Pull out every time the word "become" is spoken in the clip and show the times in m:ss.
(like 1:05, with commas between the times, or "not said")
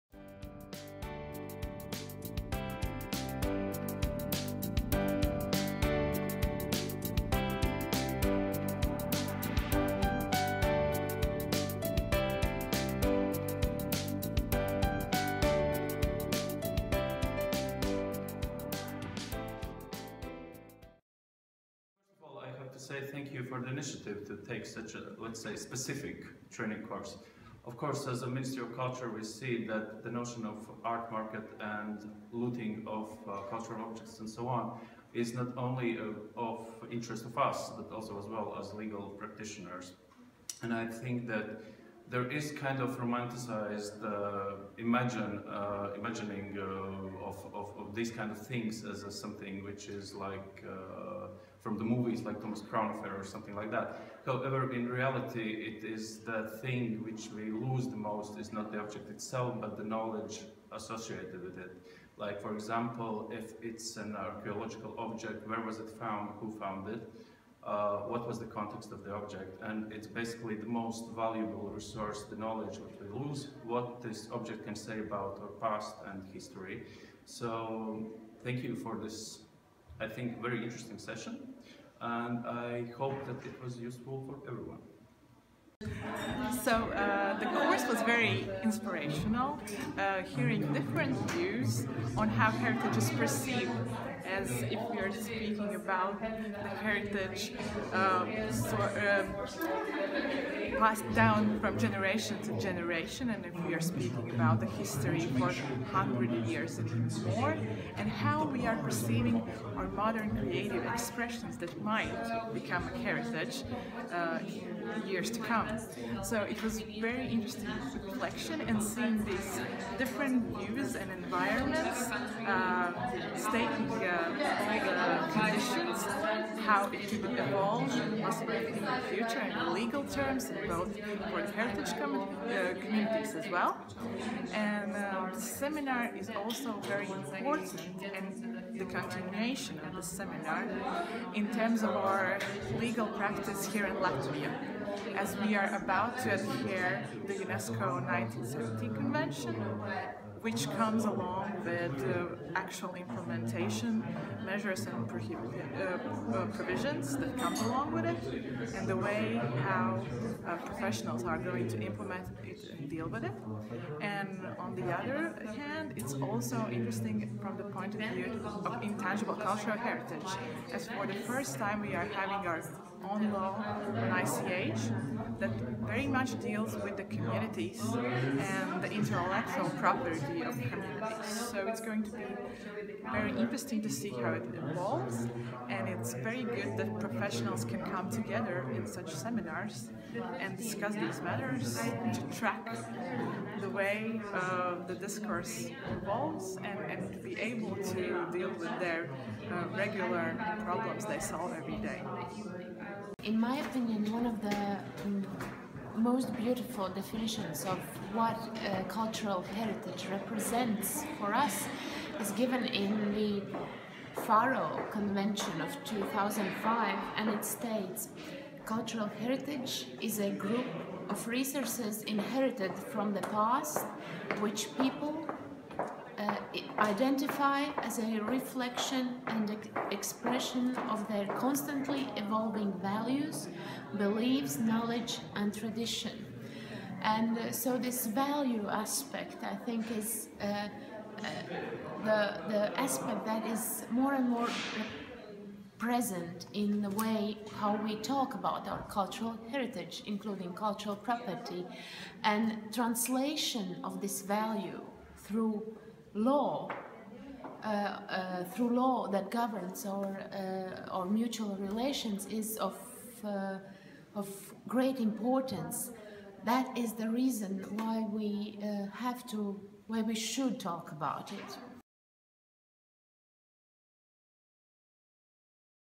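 1:52.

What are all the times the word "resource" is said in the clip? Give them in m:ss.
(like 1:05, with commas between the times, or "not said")
1:11, 3:41.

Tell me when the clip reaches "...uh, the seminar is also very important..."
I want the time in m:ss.
2:14.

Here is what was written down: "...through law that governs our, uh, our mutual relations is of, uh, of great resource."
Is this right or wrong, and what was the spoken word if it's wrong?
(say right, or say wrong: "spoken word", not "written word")
wrong: "importance", not "resource".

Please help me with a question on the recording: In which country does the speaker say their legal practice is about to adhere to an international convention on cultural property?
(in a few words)
Latvia.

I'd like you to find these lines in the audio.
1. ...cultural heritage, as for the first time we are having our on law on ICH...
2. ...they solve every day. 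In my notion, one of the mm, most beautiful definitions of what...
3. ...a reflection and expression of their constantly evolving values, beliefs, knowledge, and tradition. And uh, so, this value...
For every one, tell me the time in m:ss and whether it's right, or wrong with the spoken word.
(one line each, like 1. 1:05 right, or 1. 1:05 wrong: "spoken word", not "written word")
1. 2:49 right
2. 3:21 wrong: "opinion", not "notion"
3. 3:47 right.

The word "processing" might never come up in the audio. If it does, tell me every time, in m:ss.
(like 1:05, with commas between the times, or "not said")
not said.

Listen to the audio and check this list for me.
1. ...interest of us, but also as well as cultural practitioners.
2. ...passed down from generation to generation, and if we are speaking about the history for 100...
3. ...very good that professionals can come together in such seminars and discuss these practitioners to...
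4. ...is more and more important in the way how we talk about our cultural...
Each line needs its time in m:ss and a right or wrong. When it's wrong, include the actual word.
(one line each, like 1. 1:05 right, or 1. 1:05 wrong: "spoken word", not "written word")
1. 0:36 wrong: "legal", not "cultural"
2. 1:40 right
3. 3:06 wrong: "matters", not "practitioners"
4. 4:03 wrong: "present", not "important".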